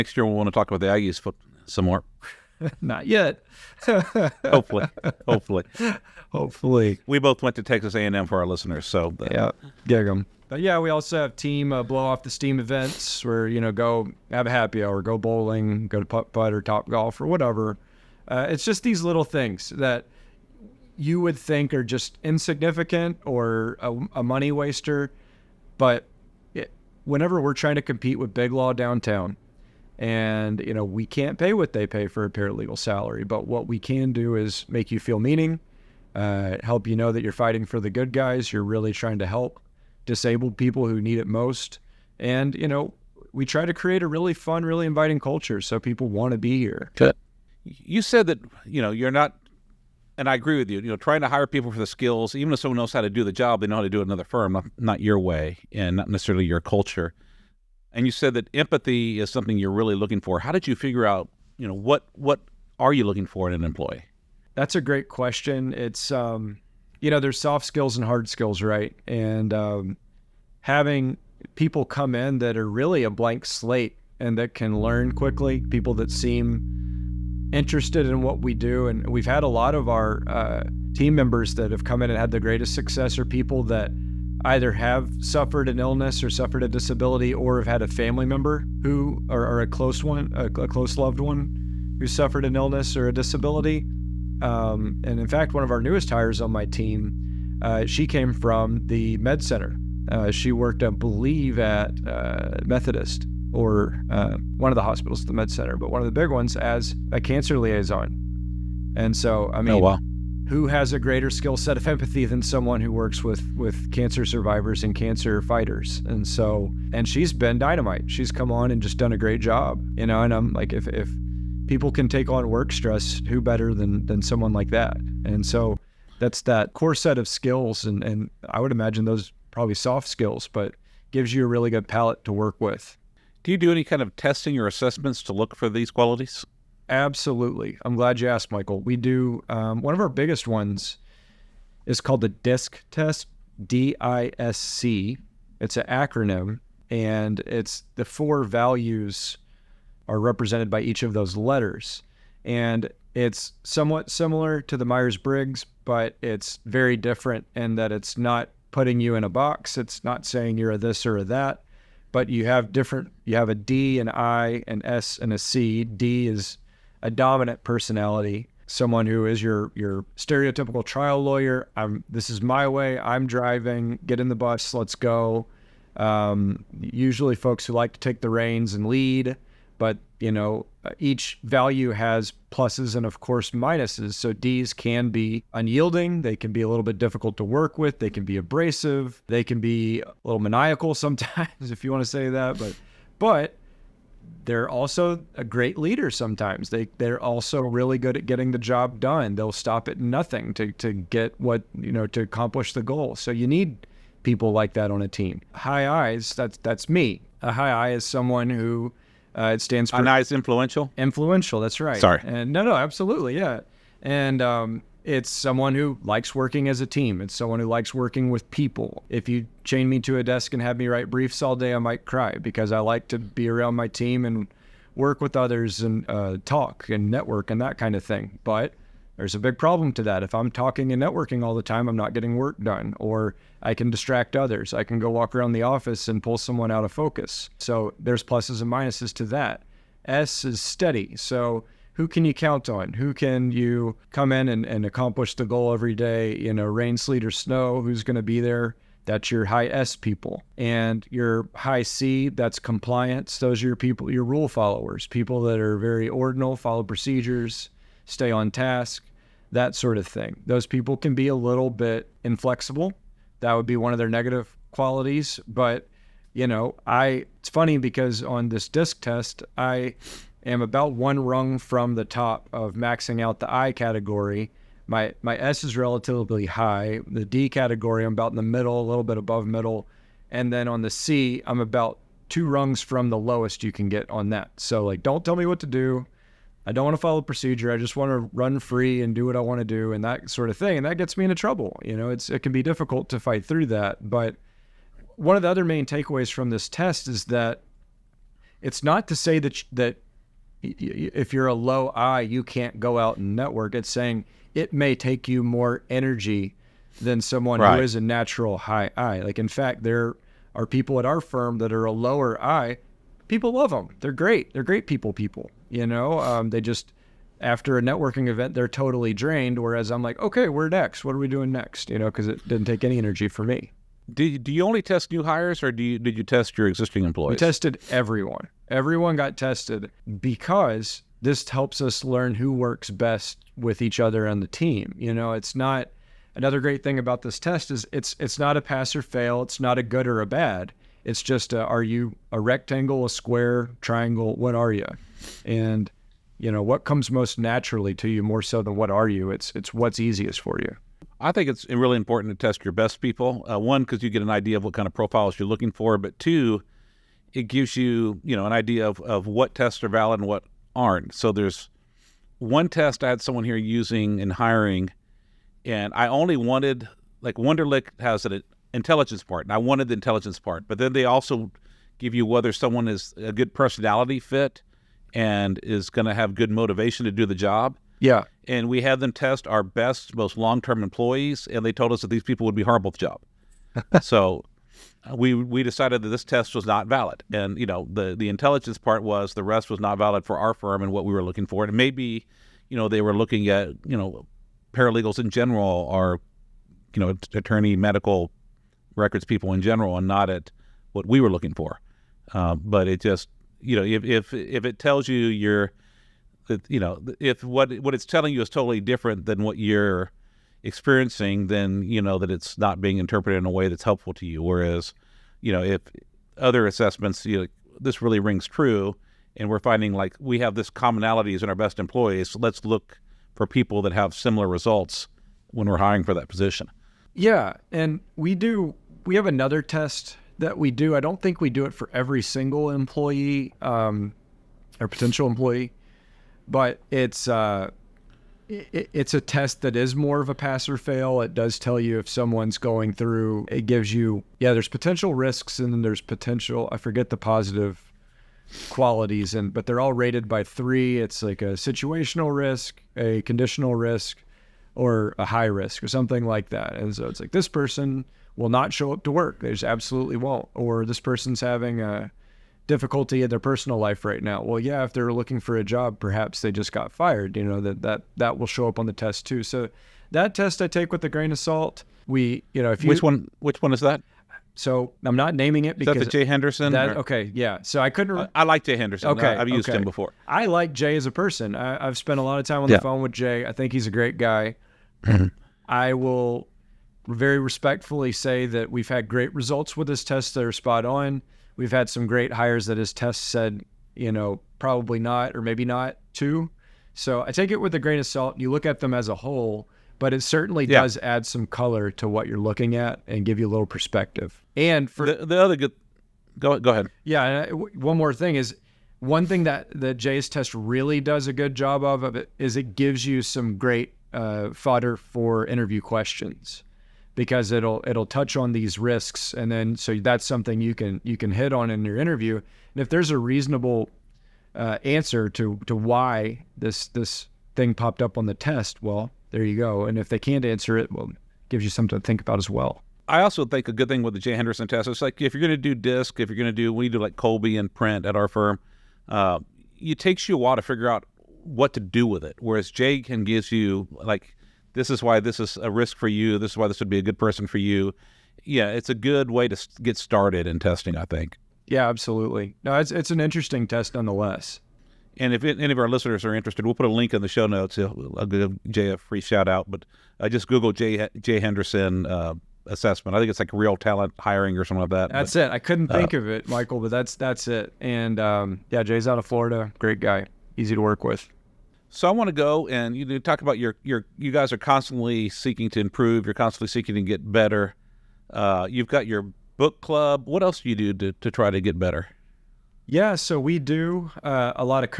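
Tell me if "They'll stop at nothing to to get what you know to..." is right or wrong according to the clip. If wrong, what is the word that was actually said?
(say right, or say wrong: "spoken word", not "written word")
right.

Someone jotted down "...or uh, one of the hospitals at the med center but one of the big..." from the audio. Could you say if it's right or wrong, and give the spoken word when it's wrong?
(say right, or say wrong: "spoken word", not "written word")
right.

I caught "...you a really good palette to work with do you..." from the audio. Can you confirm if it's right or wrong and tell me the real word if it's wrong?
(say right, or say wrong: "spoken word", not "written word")
right.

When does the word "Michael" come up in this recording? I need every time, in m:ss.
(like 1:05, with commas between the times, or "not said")
2:18, 9:26.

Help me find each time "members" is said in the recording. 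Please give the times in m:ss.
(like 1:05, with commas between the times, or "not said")
1:21, 1:28.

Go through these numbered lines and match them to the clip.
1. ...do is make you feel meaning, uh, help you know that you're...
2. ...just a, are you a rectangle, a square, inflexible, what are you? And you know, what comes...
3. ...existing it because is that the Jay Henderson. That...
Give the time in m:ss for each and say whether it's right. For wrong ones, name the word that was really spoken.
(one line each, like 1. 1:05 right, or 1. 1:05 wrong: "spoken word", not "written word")
1. 0:34 right
2. 5:41 wrong: "triangle", not "inflexible"
3. 7:55 wrong: "naming", not "existing".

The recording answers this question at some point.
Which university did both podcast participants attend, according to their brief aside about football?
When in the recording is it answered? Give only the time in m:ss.
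0:07.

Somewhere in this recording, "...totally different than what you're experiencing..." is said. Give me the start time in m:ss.
6:48.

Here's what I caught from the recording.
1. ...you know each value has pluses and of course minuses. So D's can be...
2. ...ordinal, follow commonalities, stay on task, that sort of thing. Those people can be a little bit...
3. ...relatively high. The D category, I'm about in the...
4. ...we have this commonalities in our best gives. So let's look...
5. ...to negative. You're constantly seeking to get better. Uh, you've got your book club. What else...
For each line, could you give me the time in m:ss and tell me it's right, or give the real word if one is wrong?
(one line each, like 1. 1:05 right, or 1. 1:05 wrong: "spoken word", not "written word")
1. 3:00 right
2. 4:16 wrong: "procedures", not "commonalities"
3. 4:35 right
4. 7:00 wrong: "employees", not "gives"
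5. 9:35 wrong: "improve", not "negative".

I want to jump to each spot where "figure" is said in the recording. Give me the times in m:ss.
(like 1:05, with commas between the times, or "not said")
1:00, 9:00.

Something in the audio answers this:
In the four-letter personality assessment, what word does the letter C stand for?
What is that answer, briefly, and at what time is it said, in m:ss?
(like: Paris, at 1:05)
compliance, at 4:12.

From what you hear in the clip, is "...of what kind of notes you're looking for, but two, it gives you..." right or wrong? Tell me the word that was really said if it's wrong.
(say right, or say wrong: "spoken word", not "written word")
wrong: "profiles", not "notes".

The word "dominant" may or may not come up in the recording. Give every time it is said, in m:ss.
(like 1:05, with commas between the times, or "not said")
2:47.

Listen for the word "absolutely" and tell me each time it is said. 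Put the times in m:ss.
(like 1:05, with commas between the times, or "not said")
2:16, 3:32, 7:39, 9:11.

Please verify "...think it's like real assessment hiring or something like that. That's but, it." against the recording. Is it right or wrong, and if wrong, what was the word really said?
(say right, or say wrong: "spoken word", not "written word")
wrong: "talent", not "assessment".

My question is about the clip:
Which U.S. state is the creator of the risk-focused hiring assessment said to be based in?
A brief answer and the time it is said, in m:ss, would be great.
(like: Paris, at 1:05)
Florida, at 9:29.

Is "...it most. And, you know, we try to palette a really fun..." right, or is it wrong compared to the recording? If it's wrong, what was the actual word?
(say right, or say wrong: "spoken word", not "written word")
wrong: "create", not "palette".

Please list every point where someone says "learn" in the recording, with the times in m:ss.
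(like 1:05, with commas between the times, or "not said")
1:14, 5:32.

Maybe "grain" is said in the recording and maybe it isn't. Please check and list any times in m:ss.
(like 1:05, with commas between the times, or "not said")
7:51, 8:17.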